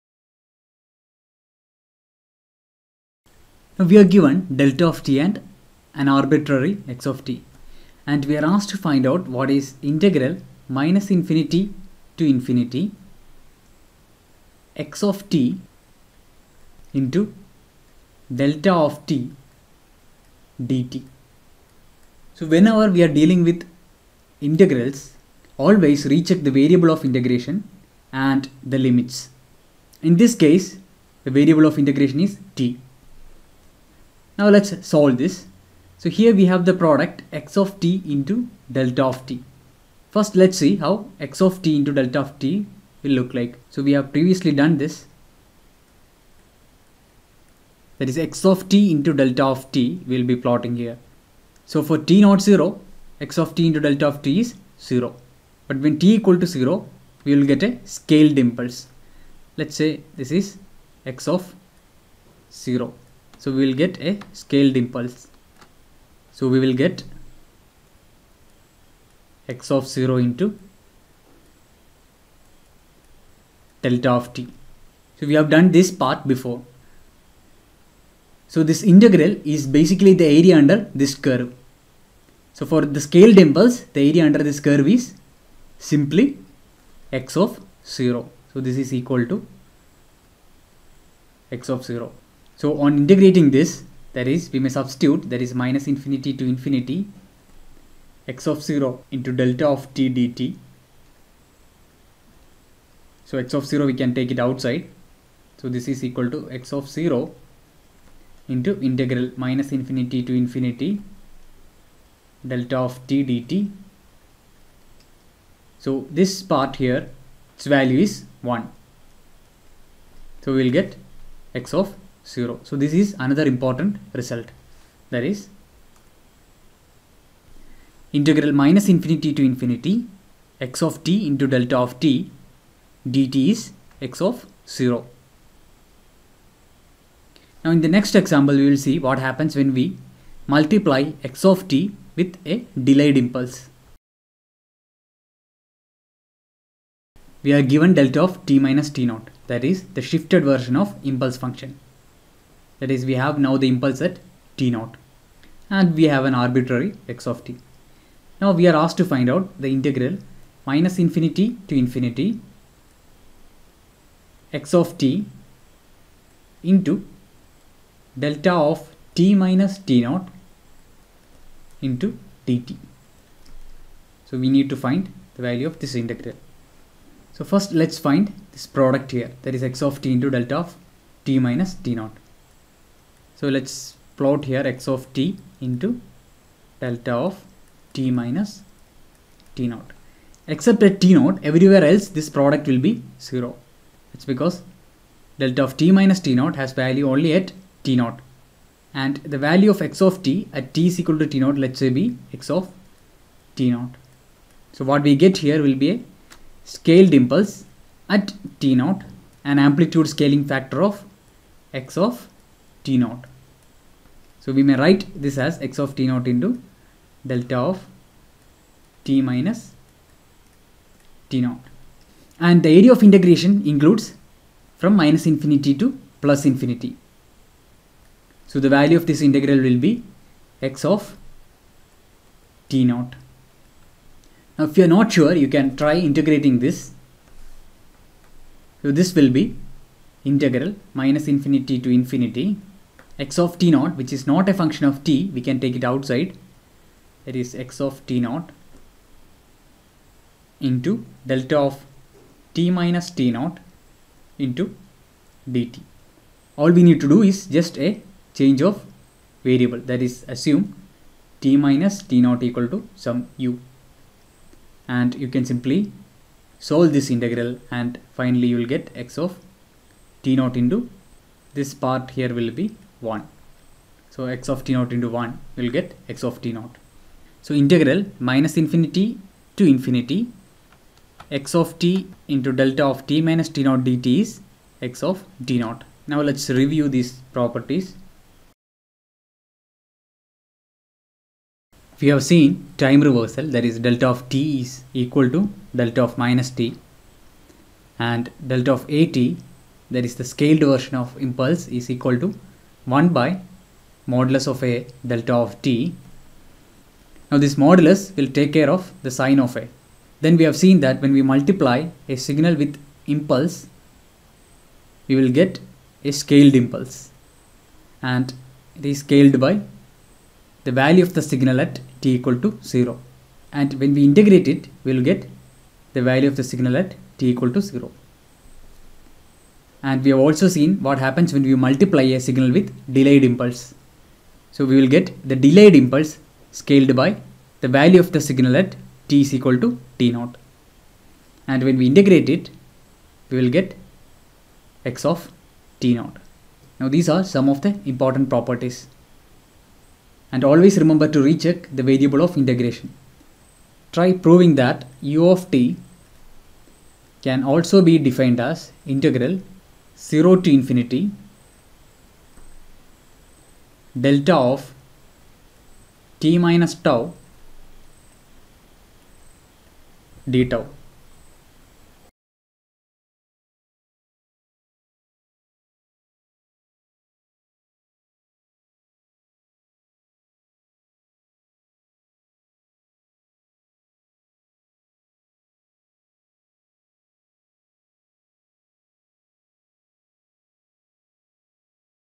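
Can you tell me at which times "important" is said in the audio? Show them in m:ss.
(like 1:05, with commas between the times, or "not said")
2:03, 5:47.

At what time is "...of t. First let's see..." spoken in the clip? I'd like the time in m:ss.
0:39.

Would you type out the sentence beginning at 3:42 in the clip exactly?
And the area of integration includes from minus infinity to plus infinity.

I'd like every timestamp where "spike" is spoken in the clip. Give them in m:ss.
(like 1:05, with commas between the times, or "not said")
not said.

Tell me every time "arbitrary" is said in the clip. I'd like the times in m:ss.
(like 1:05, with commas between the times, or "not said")
0:06, 2:36.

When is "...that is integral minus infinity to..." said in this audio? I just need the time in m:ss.
2:05.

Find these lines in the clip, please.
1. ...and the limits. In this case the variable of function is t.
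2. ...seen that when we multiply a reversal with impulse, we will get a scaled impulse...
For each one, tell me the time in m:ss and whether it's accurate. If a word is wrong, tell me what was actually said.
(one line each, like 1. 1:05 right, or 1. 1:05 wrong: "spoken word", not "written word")
1. 0:28 wrong: "integration", not "function"
2. 5:10 wrong: "signal", not "reversal".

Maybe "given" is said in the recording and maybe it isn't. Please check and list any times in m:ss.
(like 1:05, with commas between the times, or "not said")
0:04, 2:27.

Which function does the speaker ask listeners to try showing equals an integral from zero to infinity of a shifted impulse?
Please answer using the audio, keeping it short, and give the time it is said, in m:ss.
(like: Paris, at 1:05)
u of t, at 5:55.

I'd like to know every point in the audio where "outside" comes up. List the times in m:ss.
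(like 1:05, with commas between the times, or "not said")
1:44, 4:05.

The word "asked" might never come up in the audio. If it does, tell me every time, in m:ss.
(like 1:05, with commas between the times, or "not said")
0:08, 2:38.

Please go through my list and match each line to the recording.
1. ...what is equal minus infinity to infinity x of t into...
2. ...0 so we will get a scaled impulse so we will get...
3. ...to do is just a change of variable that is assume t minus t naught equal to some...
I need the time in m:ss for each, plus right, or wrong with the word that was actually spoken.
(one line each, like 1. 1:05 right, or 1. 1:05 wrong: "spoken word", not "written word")
1. 0:09 wrong: "integral", not "equal"
2. 1:02 right
3. 4:17 right.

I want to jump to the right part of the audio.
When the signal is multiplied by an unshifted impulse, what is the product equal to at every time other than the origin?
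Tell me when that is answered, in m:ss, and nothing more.
0:51.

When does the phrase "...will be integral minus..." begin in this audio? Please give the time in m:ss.
3:59.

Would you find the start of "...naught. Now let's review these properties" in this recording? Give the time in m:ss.
4:45.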